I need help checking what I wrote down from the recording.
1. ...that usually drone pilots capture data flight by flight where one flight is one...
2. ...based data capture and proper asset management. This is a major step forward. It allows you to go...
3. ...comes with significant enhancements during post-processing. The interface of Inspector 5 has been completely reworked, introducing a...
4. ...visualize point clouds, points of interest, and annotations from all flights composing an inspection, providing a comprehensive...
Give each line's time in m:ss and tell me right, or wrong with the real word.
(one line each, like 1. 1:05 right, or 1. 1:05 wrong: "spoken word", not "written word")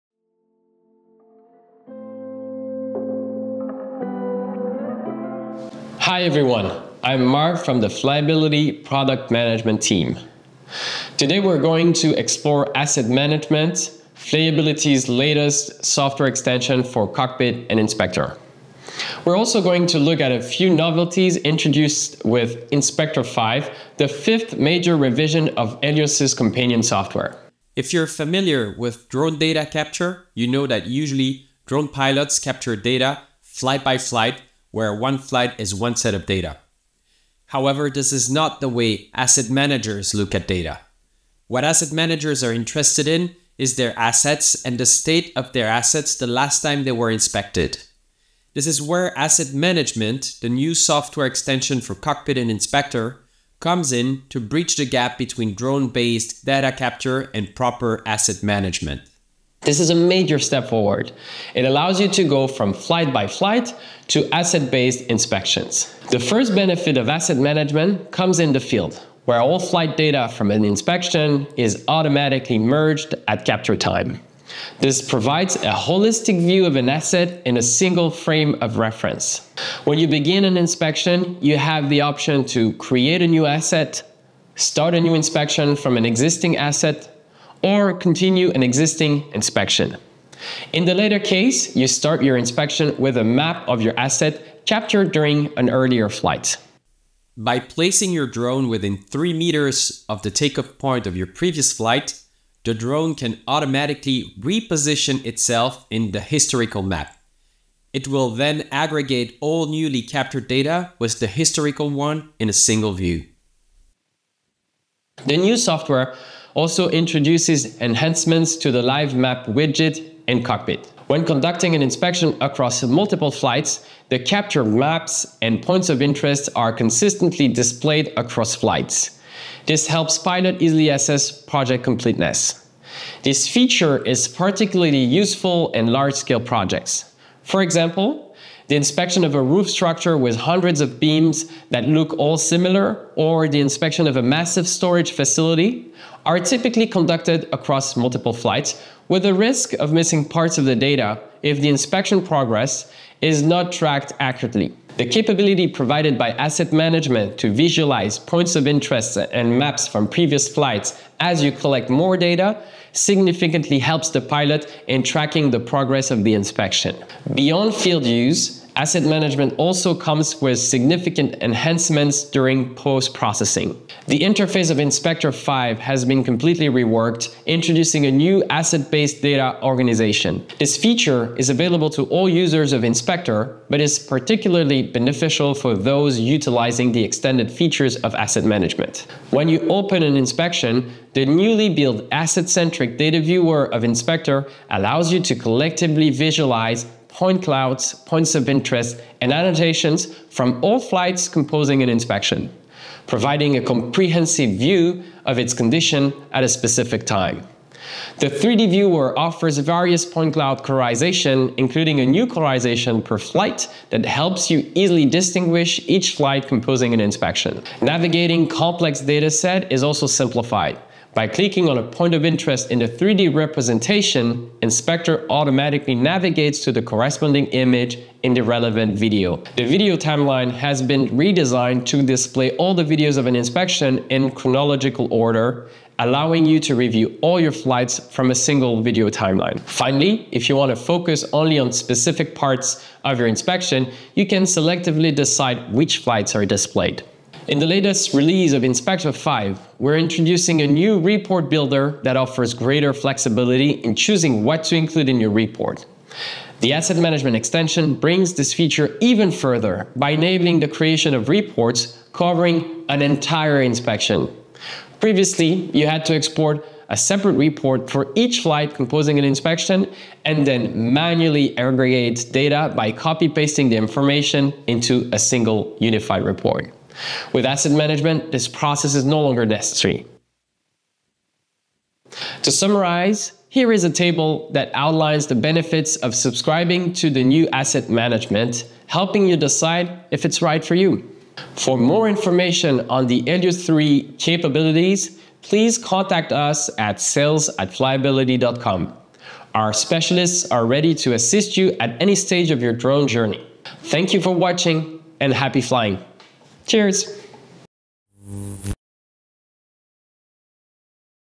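1. 0:30 right
2. 0:55 right
3. 2:49 right
4. 3:16 right.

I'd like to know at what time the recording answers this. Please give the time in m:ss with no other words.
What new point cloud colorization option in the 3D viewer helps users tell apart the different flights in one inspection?
3:32.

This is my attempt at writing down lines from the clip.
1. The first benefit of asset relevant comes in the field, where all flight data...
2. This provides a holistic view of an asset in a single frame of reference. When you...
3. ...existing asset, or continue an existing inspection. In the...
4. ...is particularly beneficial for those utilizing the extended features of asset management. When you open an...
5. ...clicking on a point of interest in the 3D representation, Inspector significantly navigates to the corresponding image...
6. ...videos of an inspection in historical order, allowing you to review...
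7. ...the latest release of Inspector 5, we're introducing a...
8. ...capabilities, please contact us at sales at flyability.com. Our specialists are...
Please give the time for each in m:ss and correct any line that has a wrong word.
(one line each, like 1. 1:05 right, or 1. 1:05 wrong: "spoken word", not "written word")
1. 1:06 wrong: "management", not "relevant"
2. 1:14 right
3. 1:26 right
4. 3:03 right
5. 3:41 wrong: "automatically", not "significantly"
6. 3:52 wrong: "chronological", not "historical"
7. 4:07 right
8. 4:54 right.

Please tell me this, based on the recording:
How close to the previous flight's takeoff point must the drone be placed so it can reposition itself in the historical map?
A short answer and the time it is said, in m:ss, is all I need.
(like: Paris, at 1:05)
3 meters, at 1:38.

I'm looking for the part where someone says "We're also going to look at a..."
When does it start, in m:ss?
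0:19.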